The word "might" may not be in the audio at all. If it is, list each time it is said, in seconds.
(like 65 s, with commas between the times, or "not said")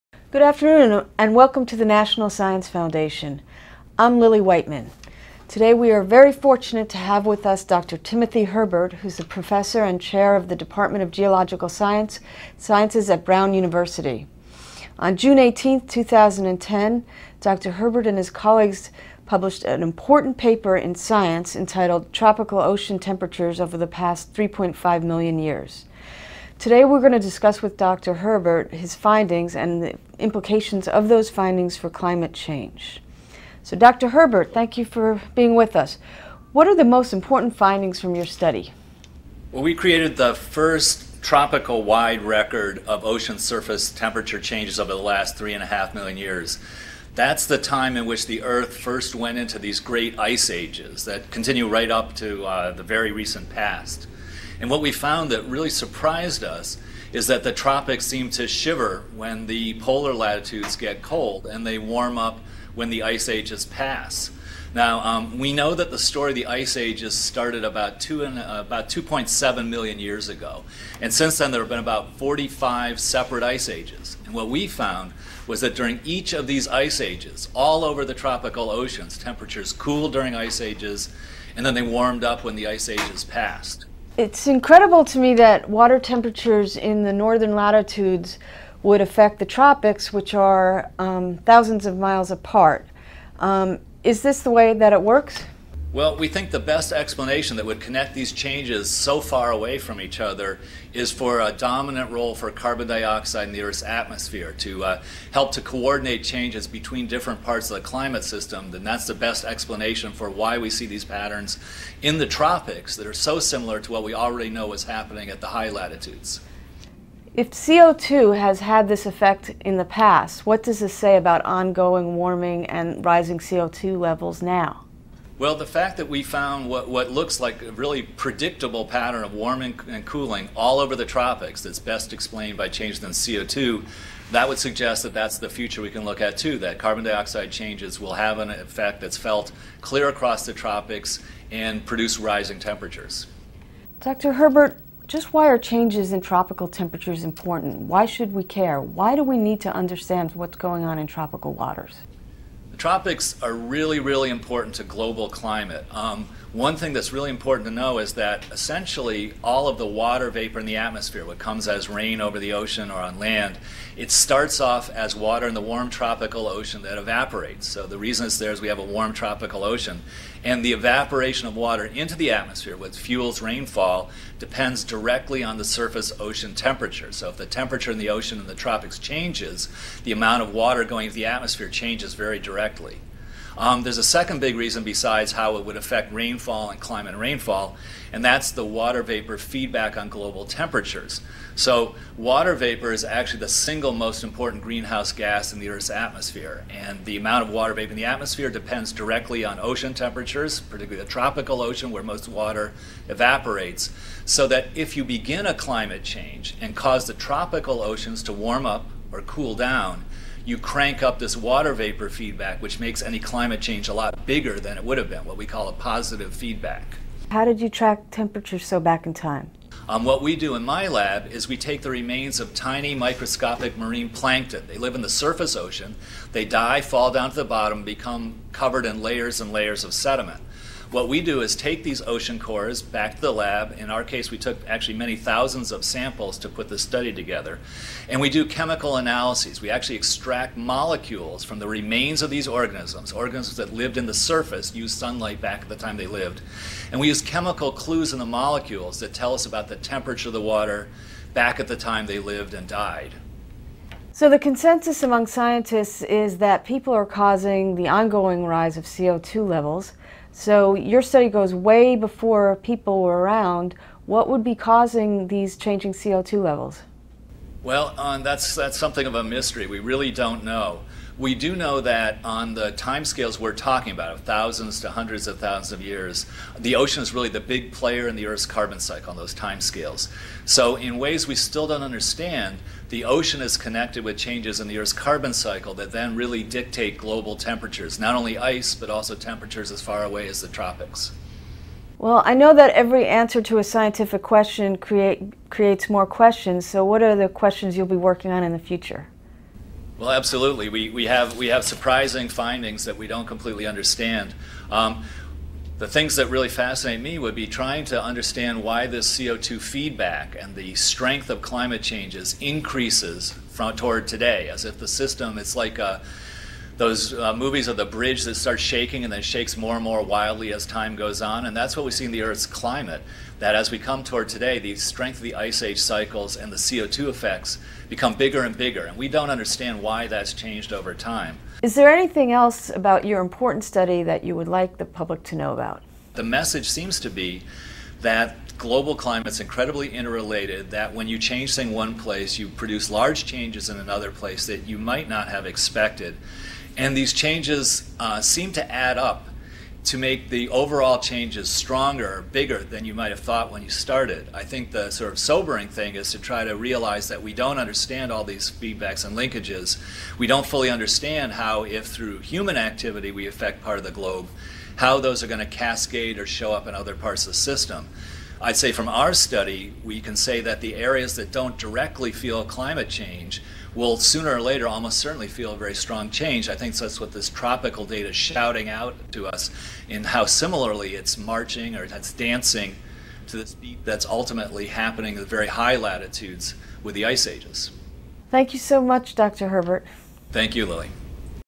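344 s, 352 s.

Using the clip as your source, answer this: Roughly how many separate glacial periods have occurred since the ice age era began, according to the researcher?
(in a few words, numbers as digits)
45.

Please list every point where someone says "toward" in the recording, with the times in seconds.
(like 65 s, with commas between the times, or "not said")
313 s, 324 s.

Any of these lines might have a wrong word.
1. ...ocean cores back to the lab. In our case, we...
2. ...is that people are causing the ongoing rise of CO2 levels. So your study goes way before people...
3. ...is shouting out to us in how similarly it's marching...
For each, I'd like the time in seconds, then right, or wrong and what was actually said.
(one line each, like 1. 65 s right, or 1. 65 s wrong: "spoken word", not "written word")
1. 232 s right
2. 256 s right
3. 378 s right.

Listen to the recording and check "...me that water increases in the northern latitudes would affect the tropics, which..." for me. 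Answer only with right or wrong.
wrong.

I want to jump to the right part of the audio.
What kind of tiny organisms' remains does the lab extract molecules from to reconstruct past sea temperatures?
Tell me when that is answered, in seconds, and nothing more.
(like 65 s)
223 s.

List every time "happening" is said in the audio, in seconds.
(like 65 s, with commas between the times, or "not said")
114 s, 384 s.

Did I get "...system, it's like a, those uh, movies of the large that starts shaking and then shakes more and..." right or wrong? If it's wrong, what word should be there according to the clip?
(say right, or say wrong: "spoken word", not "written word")
wrong: "bridge", not "large".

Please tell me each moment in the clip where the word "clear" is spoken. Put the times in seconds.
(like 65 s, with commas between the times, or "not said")
139 s.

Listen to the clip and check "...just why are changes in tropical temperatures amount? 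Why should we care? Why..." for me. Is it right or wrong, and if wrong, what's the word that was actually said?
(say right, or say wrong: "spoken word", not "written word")
wrong: "important", not "amount".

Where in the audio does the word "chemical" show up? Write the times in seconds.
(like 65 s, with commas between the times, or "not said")
238 s, 247 s.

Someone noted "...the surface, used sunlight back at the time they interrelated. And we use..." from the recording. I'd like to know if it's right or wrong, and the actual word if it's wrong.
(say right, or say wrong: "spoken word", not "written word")
wrong: "lived", not "interrelated".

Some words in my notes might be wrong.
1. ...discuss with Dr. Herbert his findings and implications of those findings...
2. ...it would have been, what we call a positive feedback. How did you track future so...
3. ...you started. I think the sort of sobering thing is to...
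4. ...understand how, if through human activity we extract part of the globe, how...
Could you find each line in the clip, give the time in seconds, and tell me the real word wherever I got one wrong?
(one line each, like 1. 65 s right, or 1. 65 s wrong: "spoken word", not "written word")
1. 27 s right
2. 214 s wrong: "temperature", not "future"
3. 353 s right
4. 360 s wrong: "affect", not "extract".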